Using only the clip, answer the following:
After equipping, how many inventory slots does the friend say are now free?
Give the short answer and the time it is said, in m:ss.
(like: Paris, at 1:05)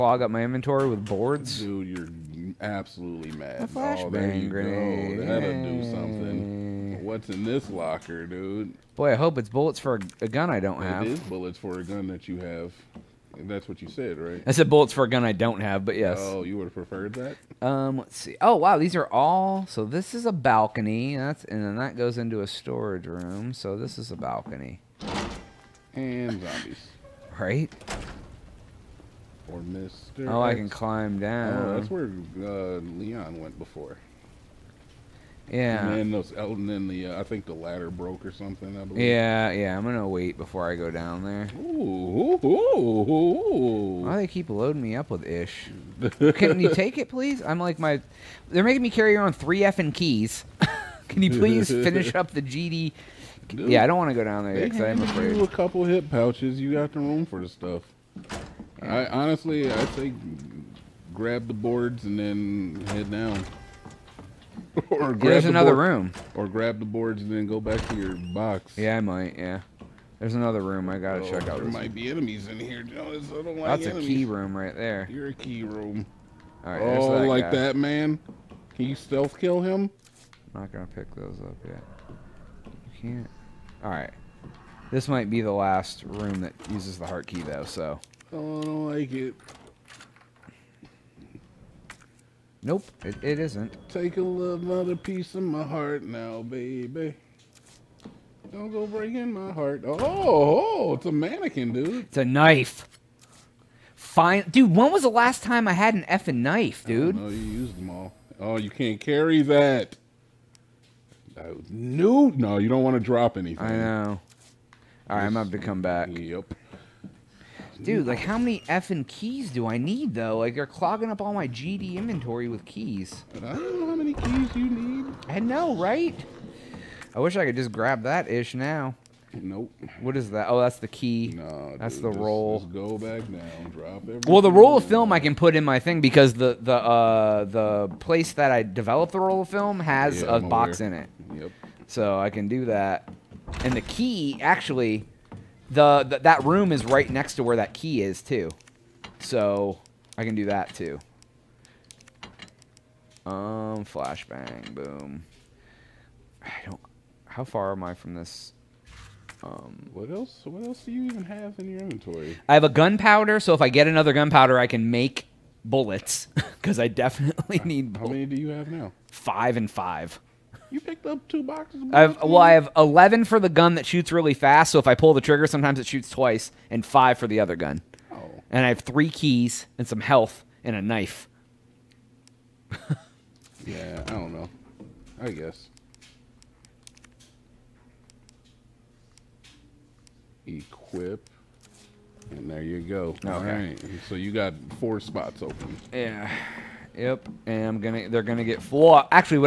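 4, at 3:14.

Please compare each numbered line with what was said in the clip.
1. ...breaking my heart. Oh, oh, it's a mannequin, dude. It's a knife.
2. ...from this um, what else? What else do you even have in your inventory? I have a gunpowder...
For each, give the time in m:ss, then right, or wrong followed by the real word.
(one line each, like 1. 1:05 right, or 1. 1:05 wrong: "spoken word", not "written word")
1. 1:38 right
2. 2:37 right.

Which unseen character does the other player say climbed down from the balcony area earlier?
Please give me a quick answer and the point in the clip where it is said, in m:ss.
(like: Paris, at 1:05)
Leon, at 0:32.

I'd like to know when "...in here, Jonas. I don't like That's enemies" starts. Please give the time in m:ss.
1:12.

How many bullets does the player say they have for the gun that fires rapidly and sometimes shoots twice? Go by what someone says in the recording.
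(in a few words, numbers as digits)
11.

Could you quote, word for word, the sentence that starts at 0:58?
I honestly, I say grab the boards and then head down.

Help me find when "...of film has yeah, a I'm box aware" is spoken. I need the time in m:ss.
2:19.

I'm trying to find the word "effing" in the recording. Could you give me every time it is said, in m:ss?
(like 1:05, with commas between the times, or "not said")
0:49, 1:46, 1:58.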